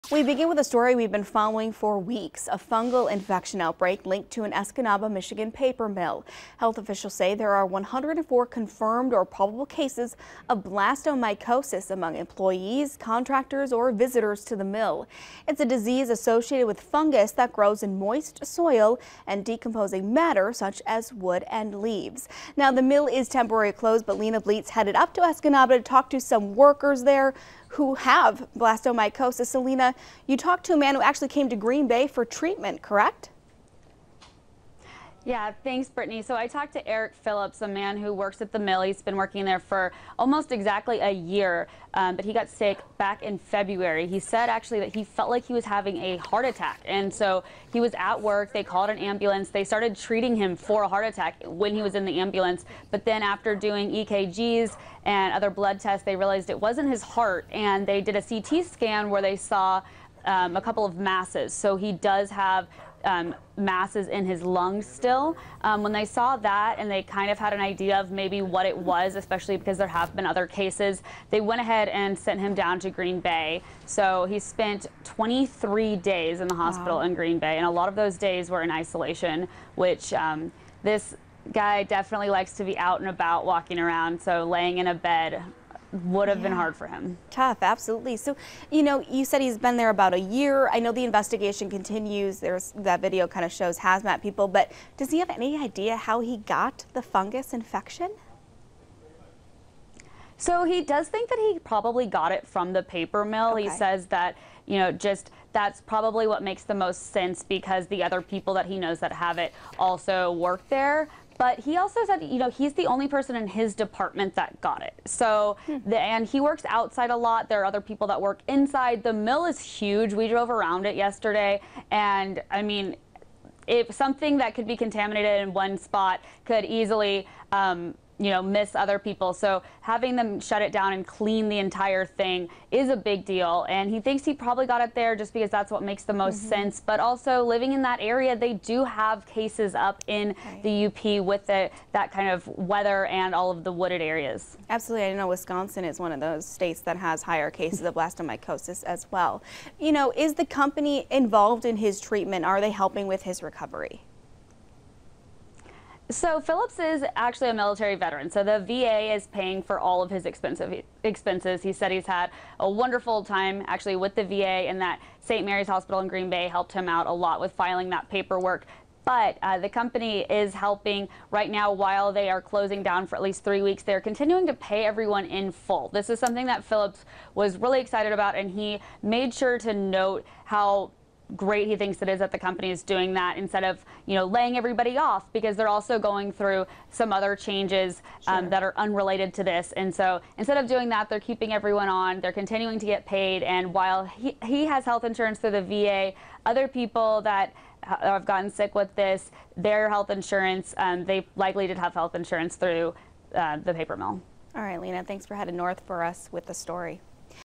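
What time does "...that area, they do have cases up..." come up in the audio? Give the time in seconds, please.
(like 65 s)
137 s.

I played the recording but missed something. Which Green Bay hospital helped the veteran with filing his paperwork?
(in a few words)
St. Mary's Hospital.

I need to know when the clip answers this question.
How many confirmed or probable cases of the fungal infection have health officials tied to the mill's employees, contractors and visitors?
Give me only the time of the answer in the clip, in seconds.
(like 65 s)
7 s.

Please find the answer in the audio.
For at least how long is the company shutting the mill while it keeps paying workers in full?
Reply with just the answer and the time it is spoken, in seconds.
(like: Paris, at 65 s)
3 weeks, at 173 s.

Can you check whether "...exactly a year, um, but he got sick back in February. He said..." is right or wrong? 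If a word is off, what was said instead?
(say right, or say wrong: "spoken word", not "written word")
right.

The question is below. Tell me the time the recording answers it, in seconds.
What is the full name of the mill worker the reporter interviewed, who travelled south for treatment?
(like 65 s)
36 s.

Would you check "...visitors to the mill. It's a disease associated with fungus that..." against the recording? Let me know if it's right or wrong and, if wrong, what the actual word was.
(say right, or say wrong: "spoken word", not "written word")
right.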